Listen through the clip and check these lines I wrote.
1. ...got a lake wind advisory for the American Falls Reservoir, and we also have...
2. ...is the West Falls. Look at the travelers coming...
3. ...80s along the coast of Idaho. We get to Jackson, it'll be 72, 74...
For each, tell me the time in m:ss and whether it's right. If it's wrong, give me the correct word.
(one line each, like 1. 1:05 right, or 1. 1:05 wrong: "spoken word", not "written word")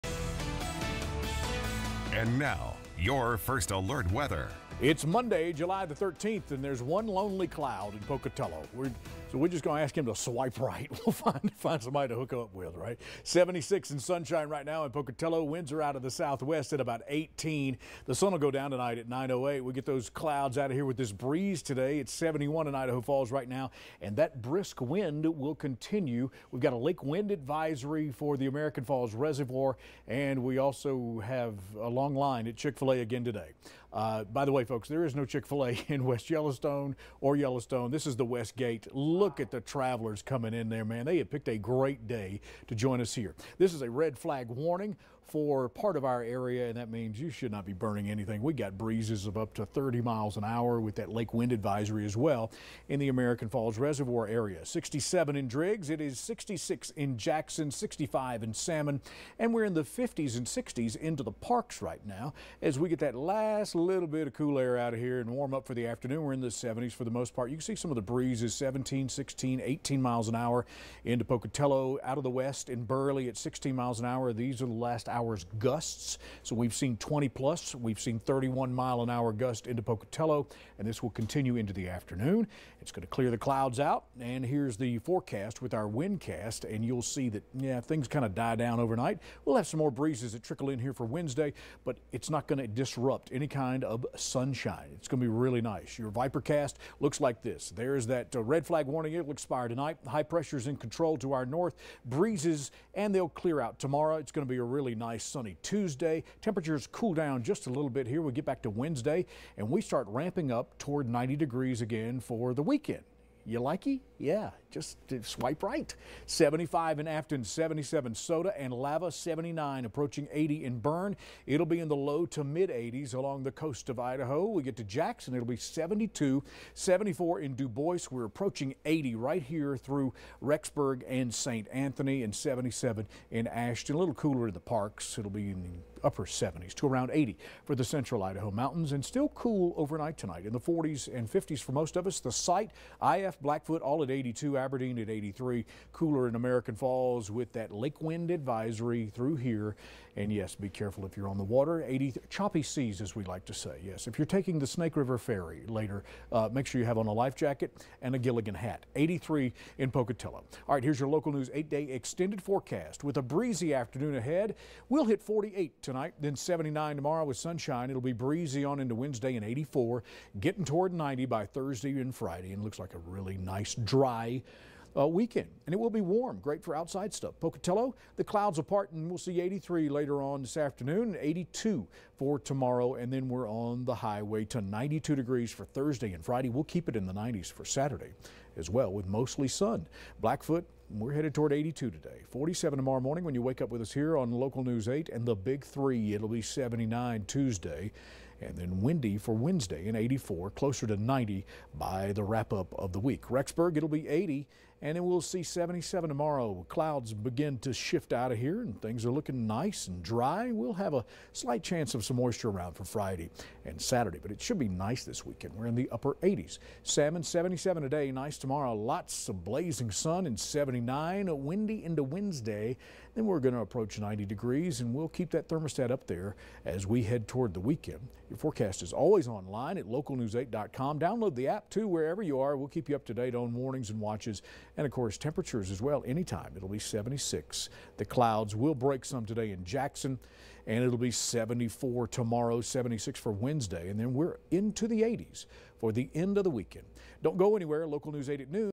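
1. 0:26 right
2. 0:38 wrong: "Gate", not "Falls"
3. 2:02 right.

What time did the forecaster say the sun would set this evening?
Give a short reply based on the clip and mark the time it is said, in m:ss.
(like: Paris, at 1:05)
9:08, at 0:19.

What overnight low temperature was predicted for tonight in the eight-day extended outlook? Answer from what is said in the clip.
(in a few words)
48.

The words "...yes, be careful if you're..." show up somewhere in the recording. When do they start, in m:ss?
2:30.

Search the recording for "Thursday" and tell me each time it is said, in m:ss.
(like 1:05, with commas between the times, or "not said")
2:51, 3:05.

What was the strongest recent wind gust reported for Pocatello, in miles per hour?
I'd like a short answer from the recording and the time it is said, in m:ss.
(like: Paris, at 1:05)
31, at 1:18.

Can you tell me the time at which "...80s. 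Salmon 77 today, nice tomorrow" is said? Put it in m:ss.
3:36.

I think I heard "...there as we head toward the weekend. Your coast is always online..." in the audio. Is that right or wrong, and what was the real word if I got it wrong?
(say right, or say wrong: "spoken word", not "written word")
wrong: "forecast", not "coast".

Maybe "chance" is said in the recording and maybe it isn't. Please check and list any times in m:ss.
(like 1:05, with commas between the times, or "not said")
3:31.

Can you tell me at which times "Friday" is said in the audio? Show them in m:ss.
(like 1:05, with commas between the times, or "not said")
2:52, 3:06, 3:32.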